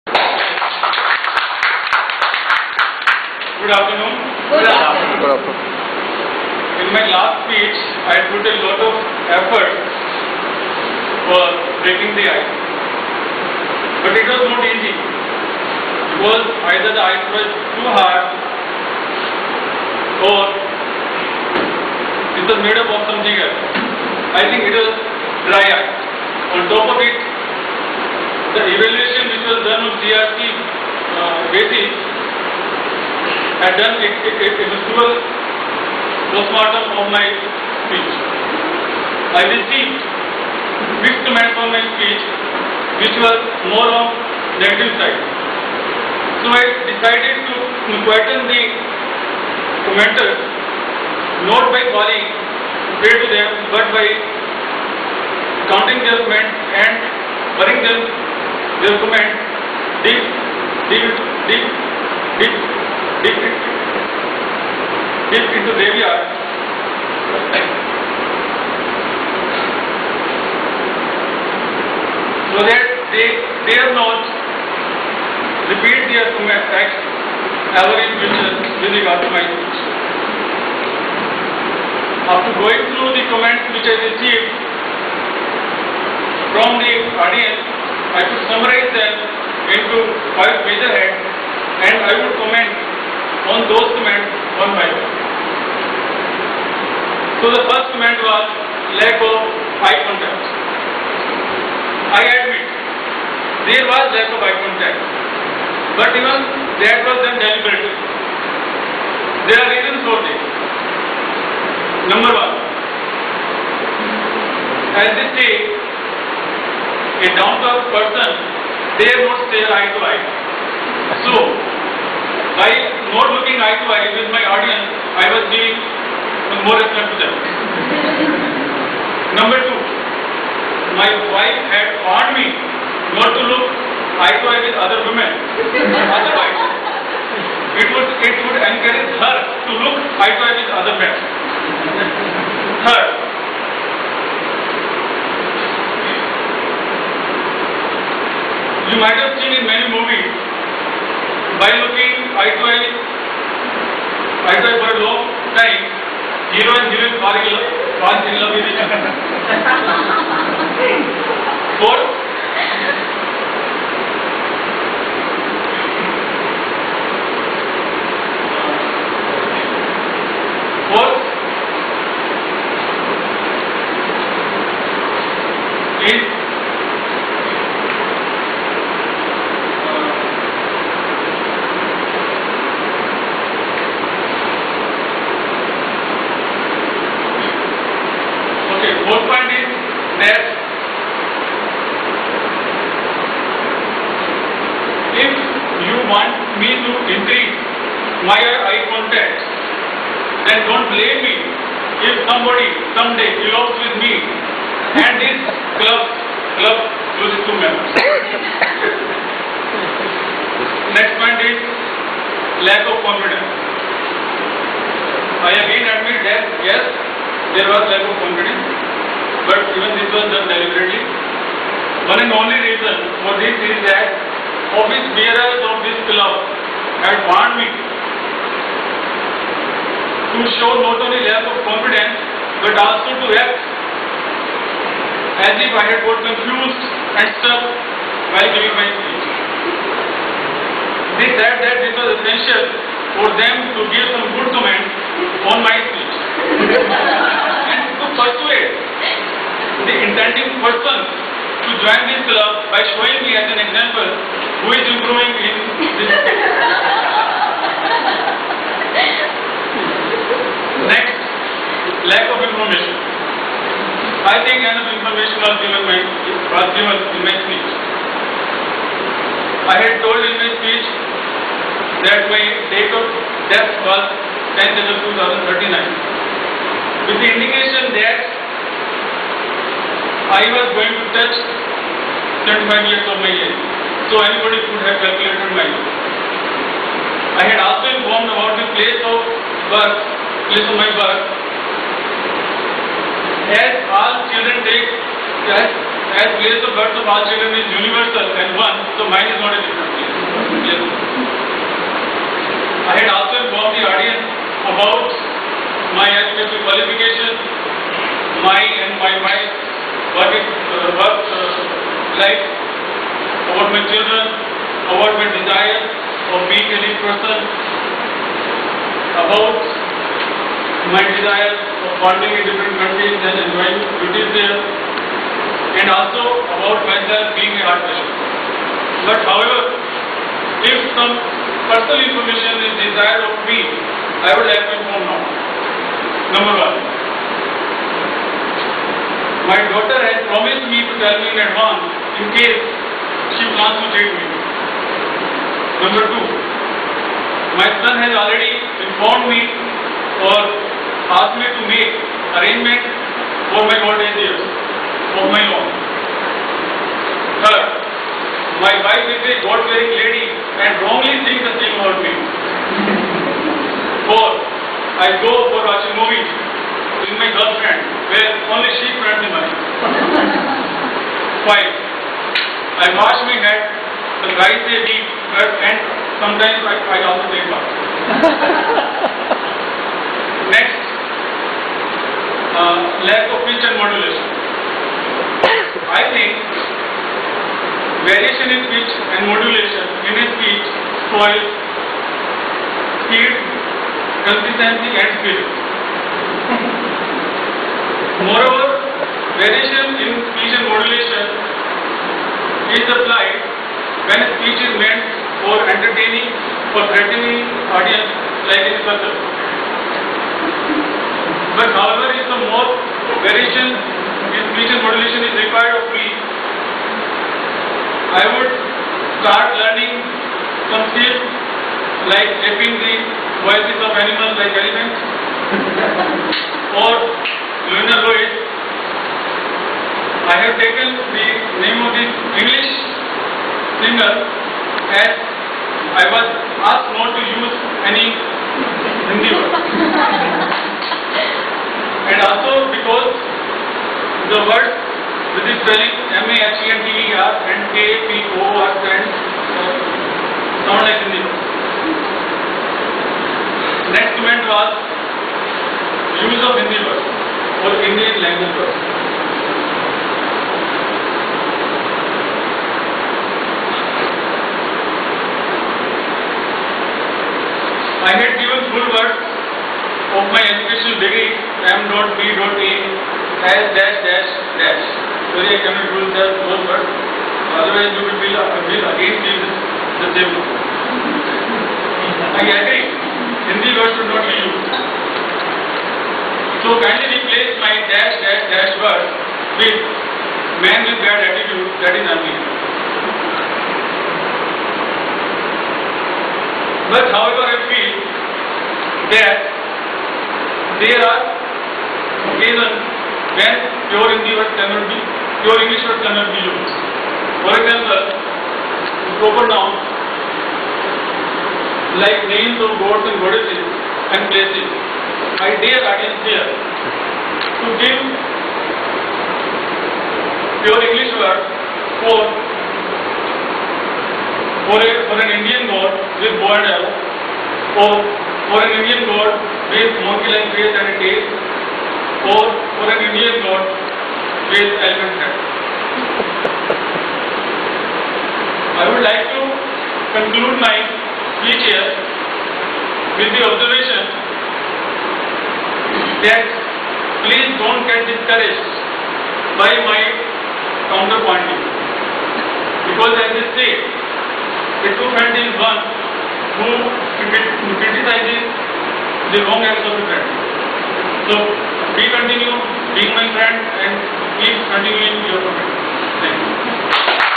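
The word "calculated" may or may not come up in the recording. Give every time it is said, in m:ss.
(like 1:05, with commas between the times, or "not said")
4:45.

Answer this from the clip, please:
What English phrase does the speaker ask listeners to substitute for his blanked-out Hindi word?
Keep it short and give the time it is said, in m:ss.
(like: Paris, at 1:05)
Man with bad attitude, at 8:10.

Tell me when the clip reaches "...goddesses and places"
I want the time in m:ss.
8:33.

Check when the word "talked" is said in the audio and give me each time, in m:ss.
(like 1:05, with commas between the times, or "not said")
not said.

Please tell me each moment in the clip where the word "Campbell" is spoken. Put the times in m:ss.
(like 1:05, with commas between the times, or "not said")
not said.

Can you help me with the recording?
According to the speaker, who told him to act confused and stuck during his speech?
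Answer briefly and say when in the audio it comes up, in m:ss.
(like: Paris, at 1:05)
Office bearers, at 3:44.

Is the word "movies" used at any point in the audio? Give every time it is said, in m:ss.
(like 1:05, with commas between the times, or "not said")
2:29, 6:05.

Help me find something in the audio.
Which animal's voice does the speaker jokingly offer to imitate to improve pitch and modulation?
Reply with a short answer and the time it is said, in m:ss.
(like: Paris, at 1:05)
Elephants, at 7:04.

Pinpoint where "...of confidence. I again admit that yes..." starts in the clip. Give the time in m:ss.
3:32.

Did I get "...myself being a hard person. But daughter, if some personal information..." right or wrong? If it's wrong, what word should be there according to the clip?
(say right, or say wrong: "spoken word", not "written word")
wrong: "however", not "daughter".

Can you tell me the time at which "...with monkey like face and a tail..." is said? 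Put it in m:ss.
8:49.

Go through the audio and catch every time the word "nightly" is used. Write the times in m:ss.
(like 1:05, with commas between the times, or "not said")
not said.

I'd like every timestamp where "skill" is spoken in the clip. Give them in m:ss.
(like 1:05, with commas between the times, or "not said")
6:35, 7:00.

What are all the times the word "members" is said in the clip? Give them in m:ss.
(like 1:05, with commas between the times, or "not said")
3:27.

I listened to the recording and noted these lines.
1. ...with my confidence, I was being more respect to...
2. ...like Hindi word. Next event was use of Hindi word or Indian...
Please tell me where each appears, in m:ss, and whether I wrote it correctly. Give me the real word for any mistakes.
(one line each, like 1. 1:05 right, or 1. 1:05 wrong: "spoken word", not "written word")
1. 2:04 wrong: "audience", not "confidence"
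2. 7:30 right.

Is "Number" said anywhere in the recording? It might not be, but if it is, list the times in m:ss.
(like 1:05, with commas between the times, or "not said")
1:52, 2:09, 5:36, 5:45.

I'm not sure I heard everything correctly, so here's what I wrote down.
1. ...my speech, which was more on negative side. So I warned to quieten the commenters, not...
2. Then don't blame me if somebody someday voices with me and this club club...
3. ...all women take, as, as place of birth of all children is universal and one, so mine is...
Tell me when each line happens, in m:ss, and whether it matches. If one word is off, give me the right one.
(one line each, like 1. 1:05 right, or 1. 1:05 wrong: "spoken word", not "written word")
1. 0:41 wrong: "decided", not "warned"
2. 3:20 wrong: "elopes", not "voices"
3. 4:53 wrong: "children", not "women".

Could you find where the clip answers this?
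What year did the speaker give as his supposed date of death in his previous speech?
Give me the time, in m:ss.
4:35.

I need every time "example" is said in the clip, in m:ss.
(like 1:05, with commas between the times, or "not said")
4:13, 8:27.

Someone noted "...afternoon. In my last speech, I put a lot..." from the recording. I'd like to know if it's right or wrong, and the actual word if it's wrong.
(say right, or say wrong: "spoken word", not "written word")
right.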